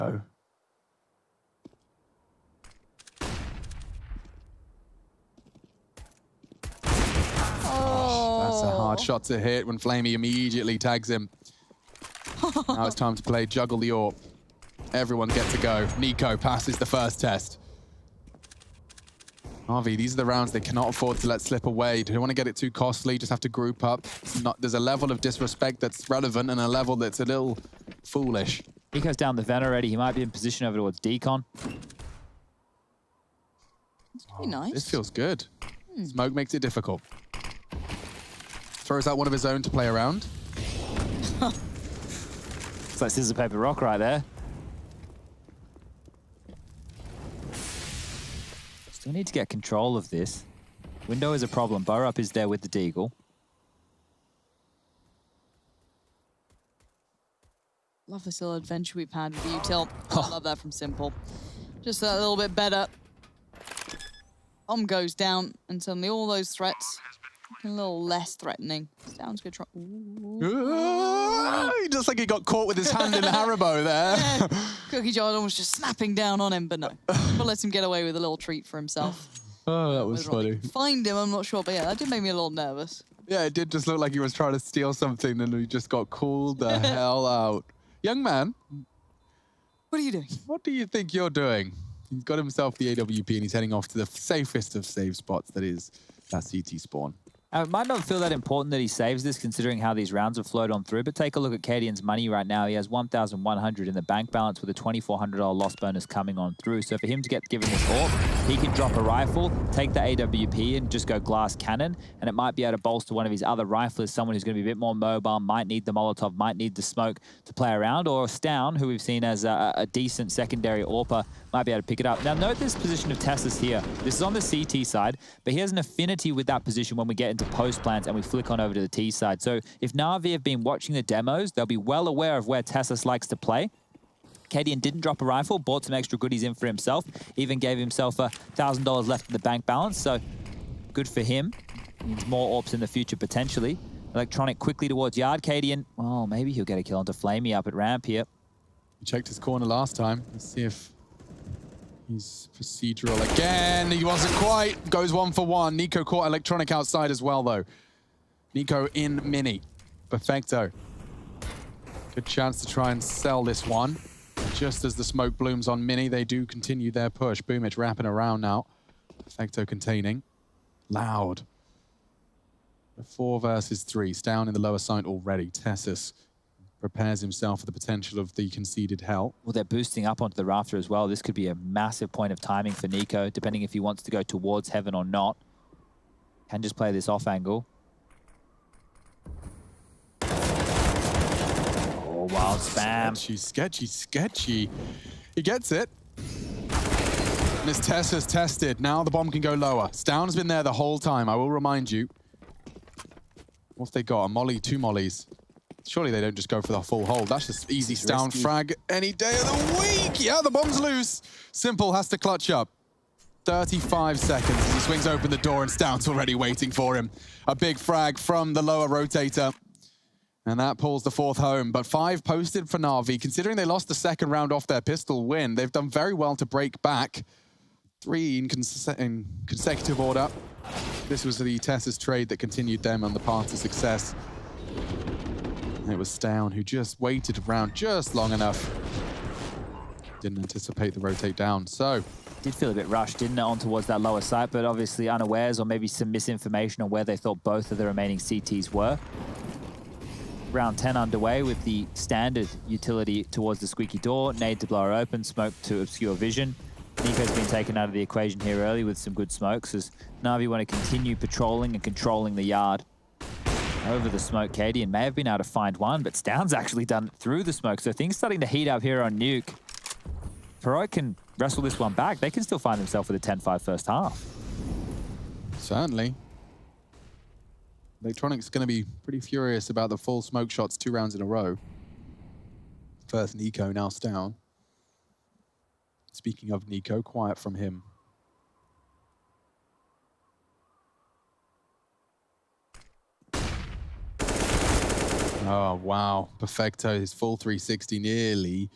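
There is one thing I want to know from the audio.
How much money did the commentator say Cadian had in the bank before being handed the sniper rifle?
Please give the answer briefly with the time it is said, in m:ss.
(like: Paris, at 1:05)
$1,100, at 1:42.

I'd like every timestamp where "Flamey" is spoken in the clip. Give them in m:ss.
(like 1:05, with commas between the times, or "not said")
0:09, 2:27.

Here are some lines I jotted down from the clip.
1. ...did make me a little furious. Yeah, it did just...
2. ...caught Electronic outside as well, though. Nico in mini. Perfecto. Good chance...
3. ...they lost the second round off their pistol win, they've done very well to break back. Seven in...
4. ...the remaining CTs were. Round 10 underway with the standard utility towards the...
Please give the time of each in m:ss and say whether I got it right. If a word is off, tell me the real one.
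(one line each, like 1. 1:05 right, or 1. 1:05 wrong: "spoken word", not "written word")
1. 1:21 wrong: "nervous", not "furious"
2. 2:36 right
3. 3:43 wrong: "Three", not "Seven"
4. 4:07 right.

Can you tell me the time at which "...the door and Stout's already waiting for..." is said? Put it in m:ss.
3:35.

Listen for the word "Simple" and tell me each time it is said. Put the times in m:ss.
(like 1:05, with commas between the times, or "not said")
1:00, 3:31.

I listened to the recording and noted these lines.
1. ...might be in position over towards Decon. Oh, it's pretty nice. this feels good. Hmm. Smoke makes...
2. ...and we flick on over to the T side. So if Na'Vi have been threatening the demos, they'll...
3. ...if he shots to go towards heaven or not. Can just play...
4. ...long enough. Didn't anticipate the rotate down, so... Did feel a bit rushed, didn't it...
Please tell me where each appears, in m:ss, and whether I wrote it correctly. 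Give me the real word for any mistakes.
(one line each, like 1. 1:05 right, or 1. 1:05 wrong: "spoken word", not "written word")
1. 0:29 right
2. 2:08 wrong: "watching", not "threatening"
3. 3:03 wrong: "wants", not "shots"
4. 3:58 right.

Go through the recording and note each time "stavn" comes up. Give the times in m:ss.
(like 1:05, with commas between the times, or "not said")
1:58, 3:19, 3:56, 4:26, 4:43.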